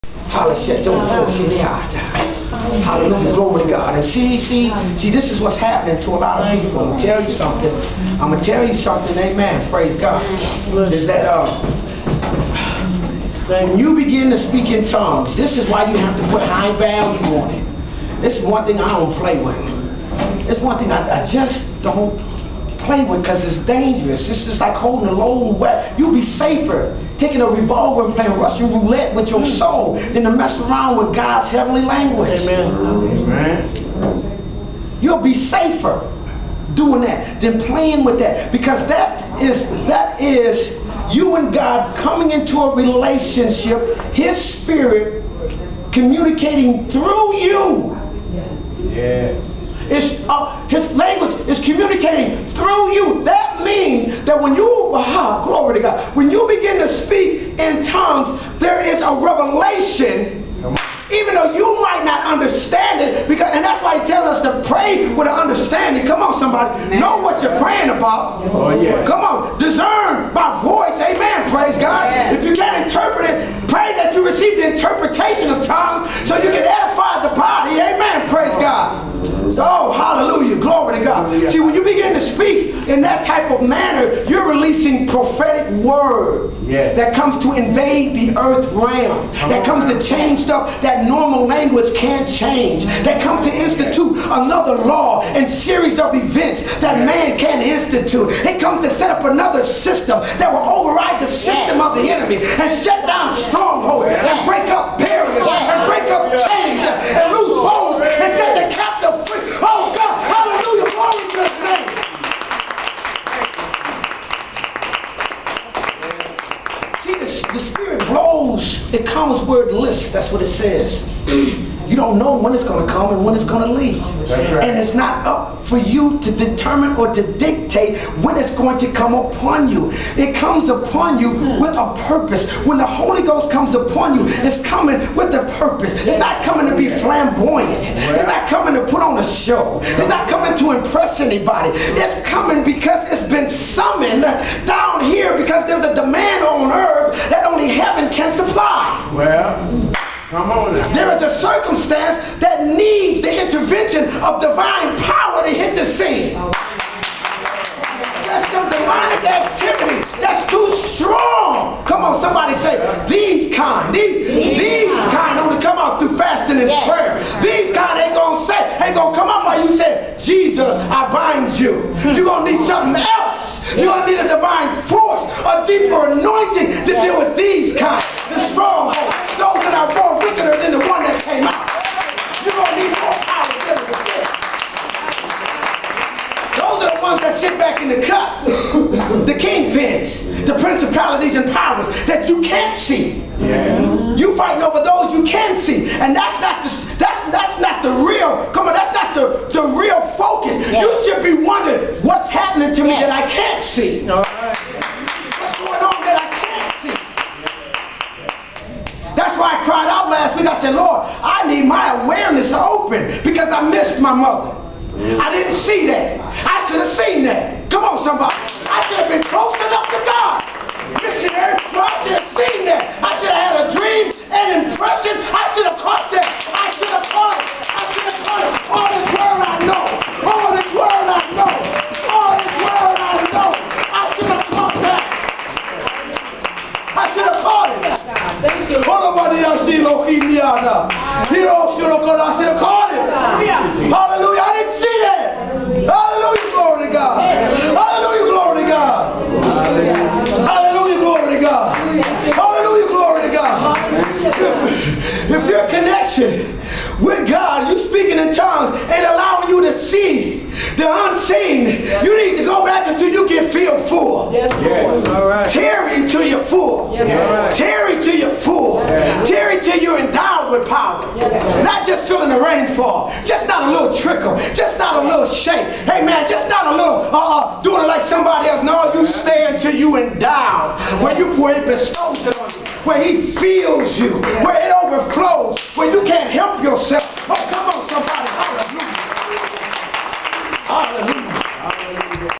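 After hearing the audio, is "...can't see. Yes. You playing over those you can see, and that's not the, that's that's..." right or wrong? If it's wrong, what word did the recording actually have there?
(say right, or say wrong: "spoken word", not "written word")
wrong: "fighting", not "playing".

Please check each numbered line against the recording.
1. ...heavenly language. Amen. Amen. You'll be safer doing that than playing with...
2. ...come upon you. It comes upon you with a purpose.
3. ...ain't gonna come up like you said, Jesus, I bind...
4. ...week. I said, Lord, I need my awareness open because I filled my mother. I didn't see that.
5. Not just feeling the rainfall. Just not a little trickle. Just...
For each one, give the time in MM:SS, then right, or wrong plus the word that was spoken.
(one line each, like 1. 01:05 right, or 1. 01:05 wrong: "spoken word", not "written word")
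1. 00:31 right
2. 02:08 right
3. 02:48 right
4. 03:30 wrong: "missed", not "filled"
5. 04:31 right.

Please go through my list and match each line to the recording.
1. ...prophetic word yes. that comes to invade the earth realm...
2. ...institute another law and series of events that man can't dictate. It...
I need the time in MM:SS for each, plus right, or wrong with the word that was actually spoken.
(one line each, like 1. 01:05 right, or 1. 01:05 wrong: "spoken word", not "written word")
1. 01:25 right
2. 01:33 wrong: "institute", not "dictate".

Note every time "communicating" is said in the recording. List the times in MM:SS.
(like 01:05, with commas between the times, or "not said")
00:45, 00:51.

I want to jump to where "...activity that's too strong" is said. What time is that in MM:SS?
02:39.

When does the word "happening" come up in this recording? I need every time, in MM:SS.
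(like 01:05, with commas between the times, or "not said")
00:05, 03:22.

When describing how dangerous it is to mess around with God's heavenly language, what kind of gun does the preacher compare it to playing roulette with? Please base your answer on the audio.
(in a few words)
Revolver.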